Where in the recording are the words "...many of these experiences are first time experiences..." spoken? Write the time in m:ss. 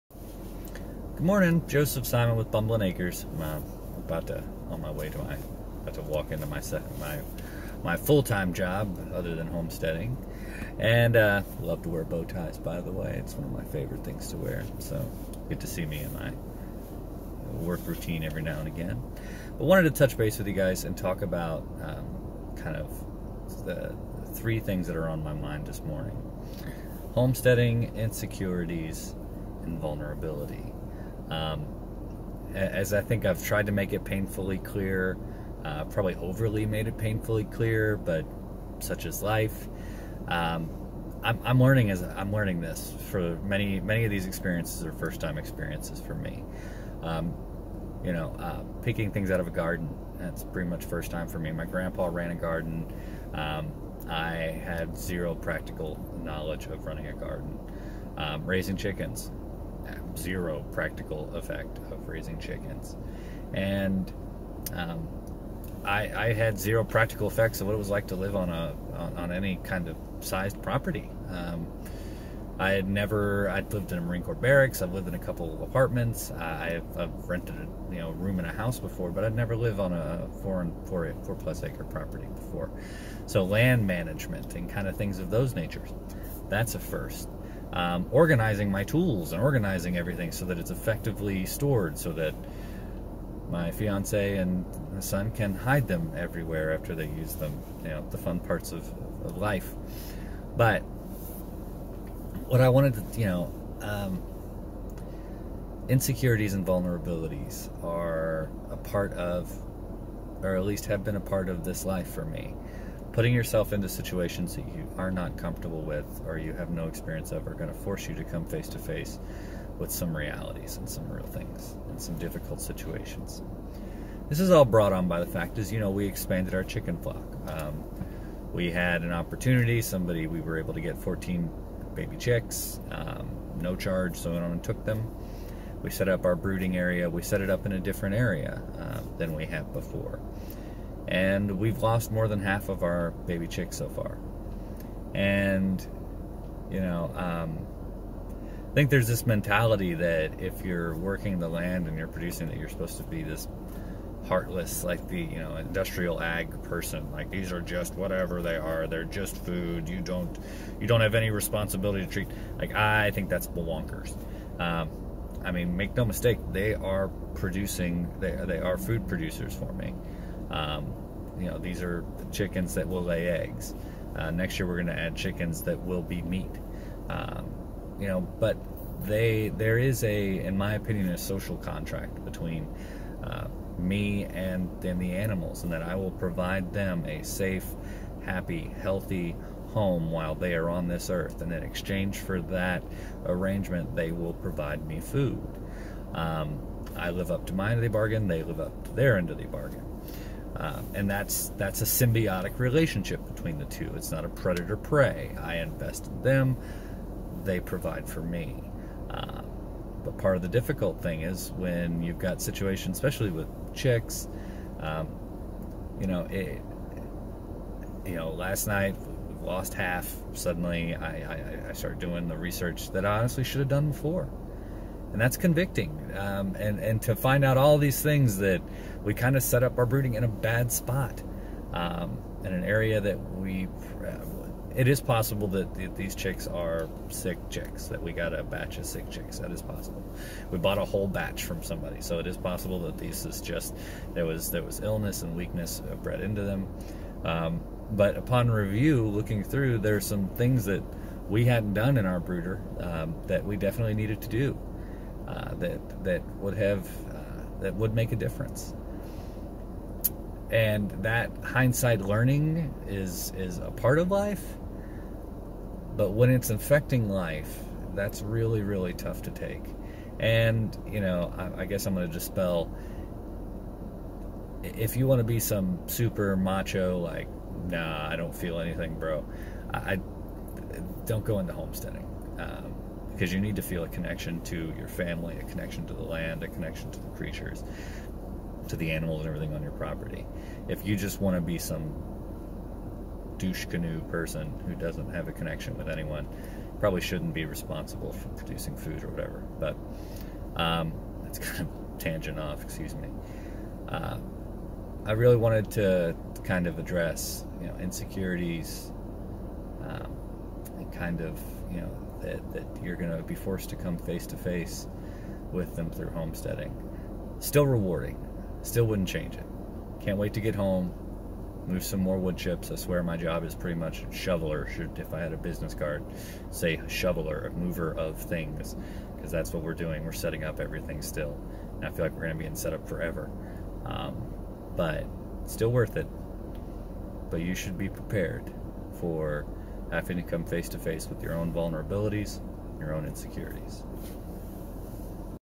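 0:43.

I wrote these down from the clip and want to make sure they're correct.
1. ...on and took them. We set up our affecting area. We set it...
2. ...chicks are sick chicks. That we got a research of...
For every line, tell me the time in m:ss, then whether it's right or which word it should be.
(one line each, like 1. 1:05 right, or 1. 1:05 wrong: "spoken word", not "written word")
1. 2:14 wrong: "brooding", not "affecting"
2. 3:56 wrong: "batch", not "research".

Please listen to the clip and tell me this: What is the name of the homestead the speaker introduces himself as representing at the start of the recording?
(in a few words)
Bumbling Acres.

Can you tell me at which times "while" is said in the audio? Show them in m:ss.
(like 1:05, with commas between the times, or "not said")
3:10.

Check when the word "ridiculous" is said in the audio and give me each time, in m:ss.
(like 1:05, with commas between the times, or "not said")
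not said.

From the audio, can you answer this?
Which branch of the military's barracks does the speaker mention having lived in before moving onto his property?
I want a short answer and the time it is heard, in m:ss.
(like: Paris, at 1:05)
Marine Corps, at 1:14.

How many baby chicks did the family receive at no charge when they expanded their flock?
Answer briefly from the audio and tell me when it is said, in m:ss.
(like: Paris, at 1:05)
14, at 2:10.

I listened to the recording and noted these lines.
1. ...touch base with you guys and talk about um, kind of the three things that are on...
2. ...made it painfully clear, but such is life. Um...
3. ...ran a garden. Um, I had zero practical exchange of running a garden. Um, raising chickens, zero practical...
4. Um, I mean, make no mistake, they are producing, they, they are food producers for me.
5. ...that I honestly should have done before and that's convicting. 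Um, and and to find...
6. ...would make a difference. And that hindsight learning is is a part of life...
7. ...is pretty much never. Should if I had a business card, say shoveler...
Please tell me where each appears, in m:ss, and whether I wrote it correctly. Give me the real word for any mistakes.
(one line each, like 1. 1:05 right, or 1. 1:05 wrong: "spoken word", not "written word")
1. 0:19 right
2. 0:36 right
3. 0:52 wrong: "knowledge", not "exchange"
4. 2:44 right
5. 3:42 right
6. 4:17 right
7. 5:23 wrong: "shoveler", not "never".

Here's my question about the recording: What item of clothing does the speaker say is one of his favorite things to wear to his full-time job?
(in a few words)
Bow ties.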